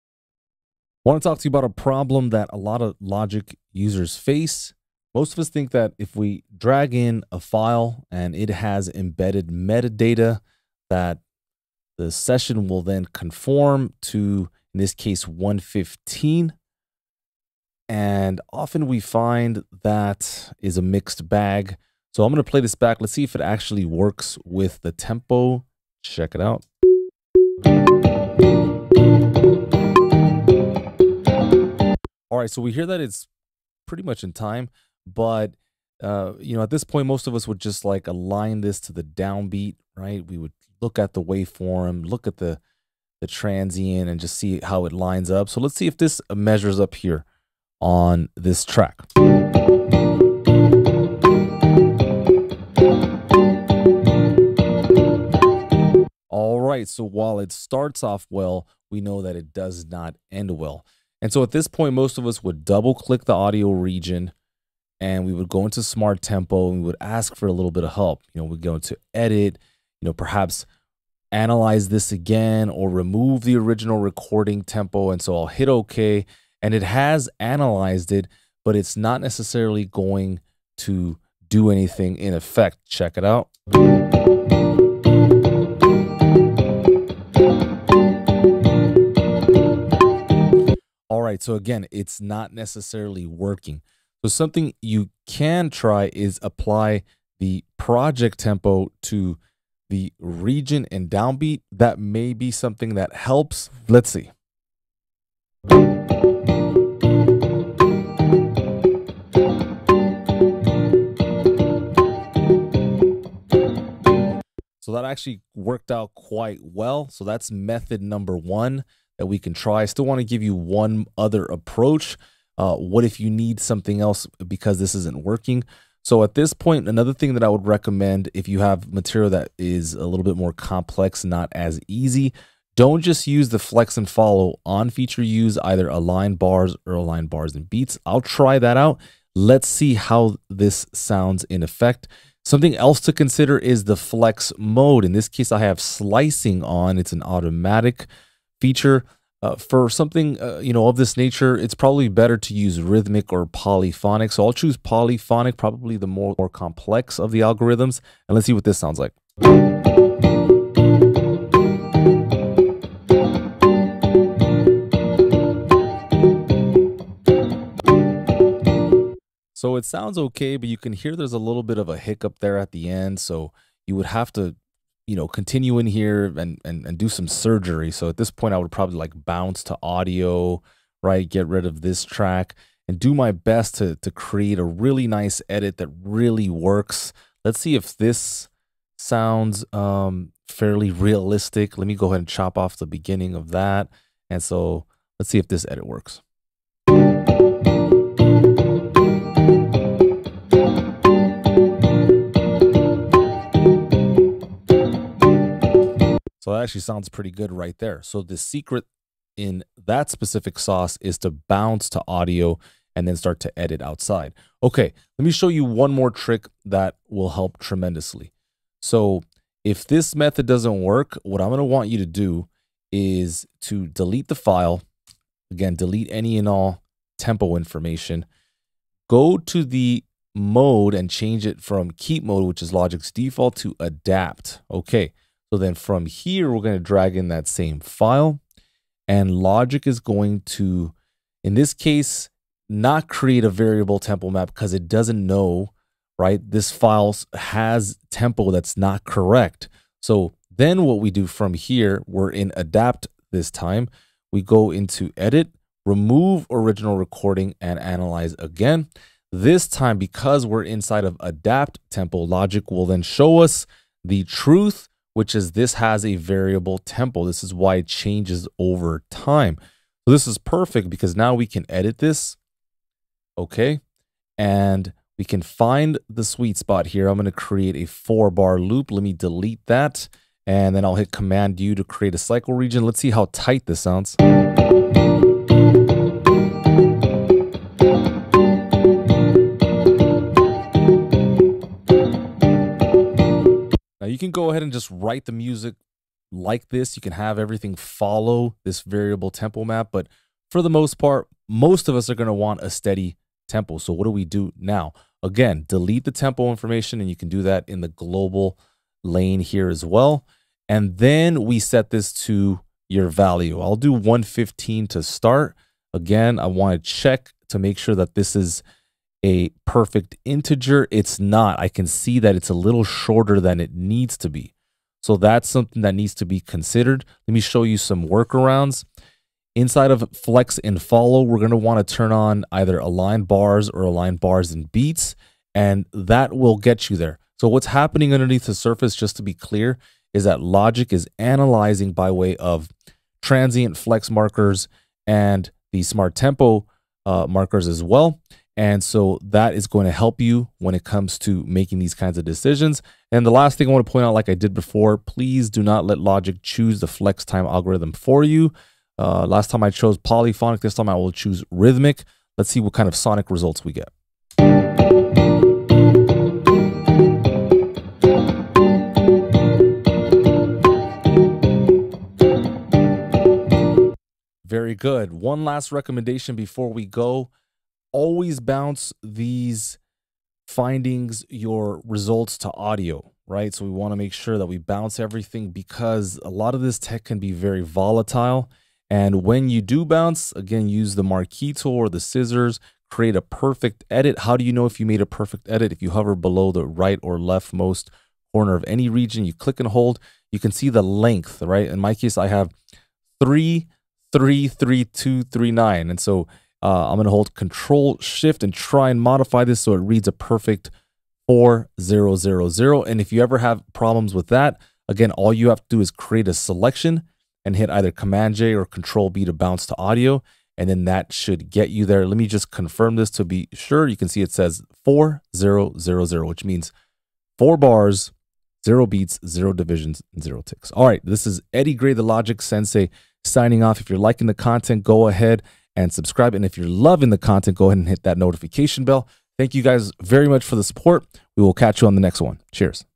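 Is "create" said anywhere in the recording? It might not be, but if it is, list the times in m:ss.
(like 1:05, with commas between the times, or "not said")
3:04, 4:03, 4:37, 4:41, 6:32, 6:55.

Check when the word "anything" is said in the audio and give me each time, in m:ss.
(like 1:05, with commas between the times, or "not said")
1:21.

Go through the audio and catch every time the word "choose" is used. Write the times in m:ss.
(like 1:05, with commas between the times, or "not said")
2:34, 5:56, 6:01.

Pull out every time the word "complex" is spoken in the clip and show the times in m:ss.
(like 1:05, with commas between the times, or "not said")
2:10, 2:36.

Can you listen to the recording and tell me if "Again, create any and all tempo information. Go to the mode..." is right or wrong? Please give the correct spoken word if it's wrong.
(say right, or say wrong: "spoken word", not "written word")
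wrong: "delete", not "create".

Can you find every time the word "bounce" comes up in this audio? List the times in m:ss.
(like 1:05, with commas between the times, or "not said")
2:59, 3:31, 6:18, 6:24, 6:29, 6:59.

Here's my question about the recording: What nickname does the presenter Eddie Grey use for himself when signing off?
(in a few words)
The Logic Sensei.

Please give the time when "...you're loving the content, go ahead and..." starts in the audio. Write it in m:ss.
7:16.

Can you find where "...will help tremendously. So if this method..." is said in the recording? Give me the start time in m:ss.
3:37.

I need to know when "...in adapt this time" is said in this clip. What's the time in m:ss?
4:12.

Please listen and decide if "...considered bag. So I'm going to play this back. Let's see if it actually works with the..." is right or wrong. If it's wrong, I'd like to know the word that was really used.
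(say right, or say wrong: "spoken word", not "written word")
wrong: "mixed", not "considered".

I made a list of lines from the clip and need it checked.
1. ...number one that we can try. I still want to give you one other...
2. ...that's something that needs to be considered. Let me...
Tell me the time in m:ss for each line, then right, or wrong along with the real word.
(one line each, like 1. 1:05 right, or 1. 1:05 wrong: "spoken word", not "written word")
1. 1:58 right
2. 5:25 right.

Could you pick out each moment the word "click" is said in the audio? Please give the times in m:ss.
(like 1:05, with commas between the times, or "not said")
1:02, 6:39.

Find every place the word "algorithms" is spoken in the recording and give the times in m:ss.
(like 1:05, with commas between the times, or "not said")
2:37, 5:57.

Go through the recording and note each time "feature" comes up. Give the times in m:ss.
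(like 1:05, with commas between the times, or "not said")
2:14, 2:28.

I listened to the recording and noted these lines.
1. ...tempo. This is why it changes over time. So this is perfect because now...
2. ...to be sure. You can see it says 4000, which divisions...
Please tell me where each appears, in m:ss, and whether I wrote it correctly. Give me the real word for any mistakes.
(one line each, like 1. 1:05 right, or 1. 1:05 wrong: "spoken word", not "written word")
1. 4:26 right
2. 7:03 wrong: "means", not "divisions".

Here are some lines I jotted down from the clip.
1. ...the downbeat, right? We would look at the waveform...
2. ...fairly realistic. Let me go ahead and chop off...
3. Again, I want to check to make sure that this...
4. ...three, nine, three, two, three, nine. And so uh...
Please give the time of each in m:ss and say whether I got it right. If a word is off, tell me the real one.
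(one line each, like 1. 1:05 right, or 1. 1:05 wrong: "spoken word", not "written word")
1. 0:38 right
2. 3:10 right
3. 5:15 right
4. 6:43 wrong: "three", not "nine".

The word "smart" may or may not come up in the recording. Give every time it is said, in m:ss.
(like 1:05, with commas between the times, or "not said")
1:05, 5:45.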